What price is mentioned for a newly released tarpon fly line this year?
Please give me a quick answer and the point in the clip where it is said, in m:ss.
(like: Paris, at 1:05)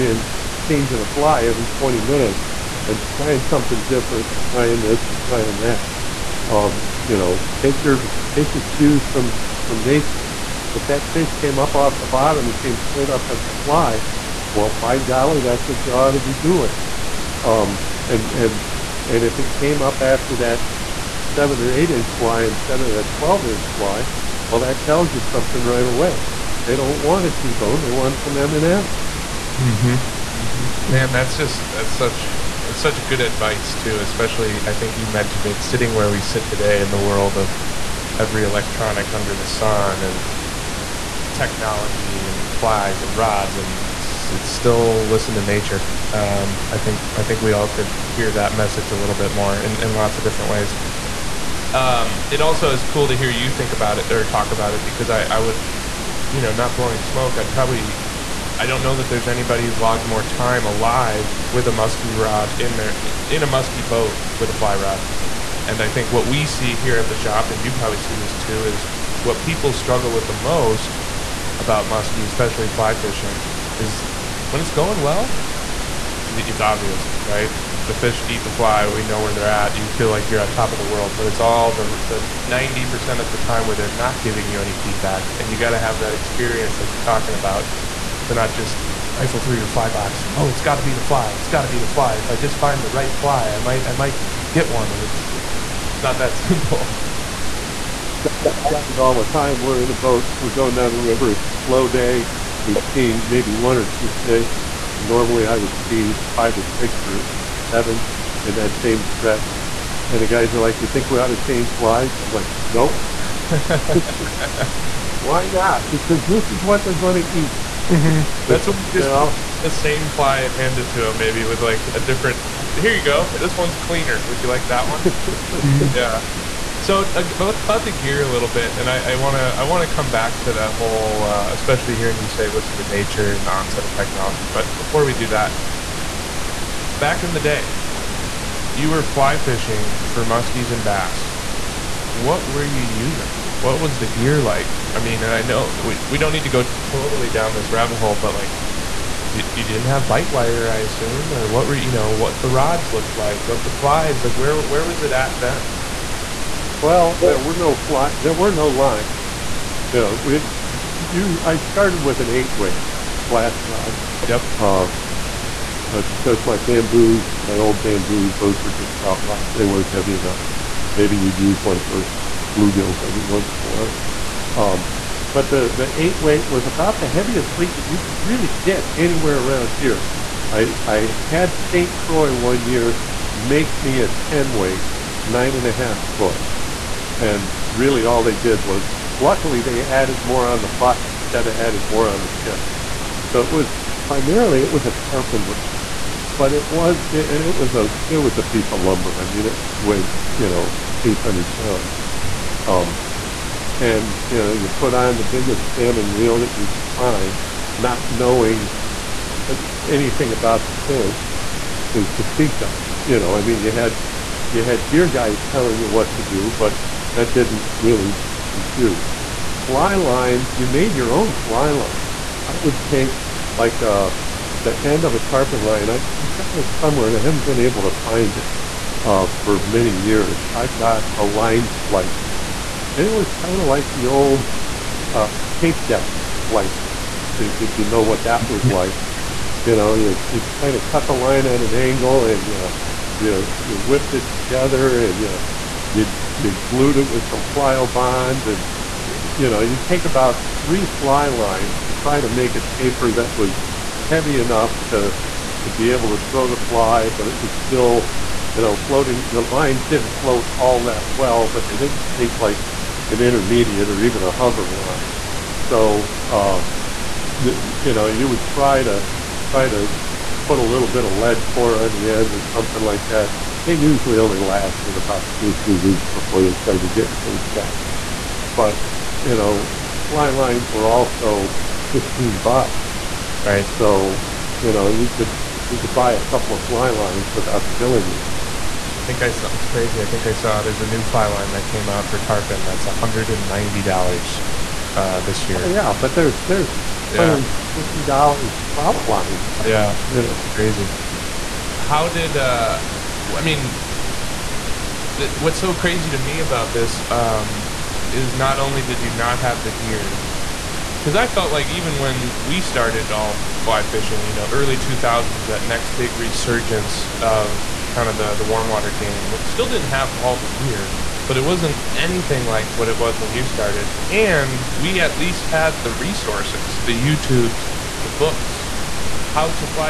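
$190, at 4:52.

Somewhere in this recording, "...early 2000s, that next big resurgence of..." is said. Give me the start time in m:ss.
5:14.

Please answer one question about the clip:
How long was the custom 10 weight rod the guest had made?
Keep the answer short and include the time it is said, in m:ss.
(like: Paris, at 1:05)
9.5 feet, at 3:05.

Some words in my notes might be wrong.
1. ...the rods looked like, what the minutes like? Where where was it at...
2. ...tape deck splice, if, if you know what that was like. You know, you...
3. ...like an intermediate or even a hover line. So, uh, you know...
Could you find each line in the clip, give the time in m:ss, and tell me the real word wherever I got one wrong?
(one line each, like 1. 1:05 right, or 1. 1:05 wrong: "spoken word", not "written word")
1. 2:32 wrong: "flies", not "minutes"
2. 3:55 right
3. 4:22 right.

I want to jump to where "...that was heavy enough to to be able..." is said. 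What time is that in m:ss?
4:13.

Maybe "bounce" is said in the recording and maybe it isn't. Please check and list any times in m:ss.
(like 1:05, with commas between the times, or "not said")
not said.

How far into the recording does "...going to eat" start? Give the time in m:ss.
1:56.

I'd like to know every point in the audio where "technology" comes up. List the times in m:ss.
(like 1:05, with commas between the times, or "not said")
0:41, 2:13.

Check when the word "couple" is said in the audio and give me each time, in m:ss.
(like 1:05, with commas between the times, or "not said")
4:46.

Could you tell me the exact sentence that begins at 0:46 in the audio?
Um, I think I think we all could hear that message a little bit more in, in lots of different ways.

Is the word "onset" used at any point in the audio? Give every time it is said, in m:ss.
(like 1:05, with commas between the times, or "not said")
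2:13.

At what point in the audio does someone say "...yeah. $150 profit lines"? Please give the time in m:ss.
4:57.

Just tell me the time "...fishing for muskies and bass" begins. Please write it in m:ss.
2:19.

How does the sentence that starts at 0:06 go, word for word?
Um, you know, take your, take your cues from, from nature.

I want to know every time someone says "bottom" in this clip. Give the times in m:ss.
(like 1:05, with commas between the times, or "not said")
0:12.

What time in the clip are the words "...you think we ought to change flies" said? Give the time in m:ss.
1:50.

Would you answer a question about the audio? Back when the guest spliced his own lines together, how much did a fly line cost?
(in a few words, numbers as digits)
$15.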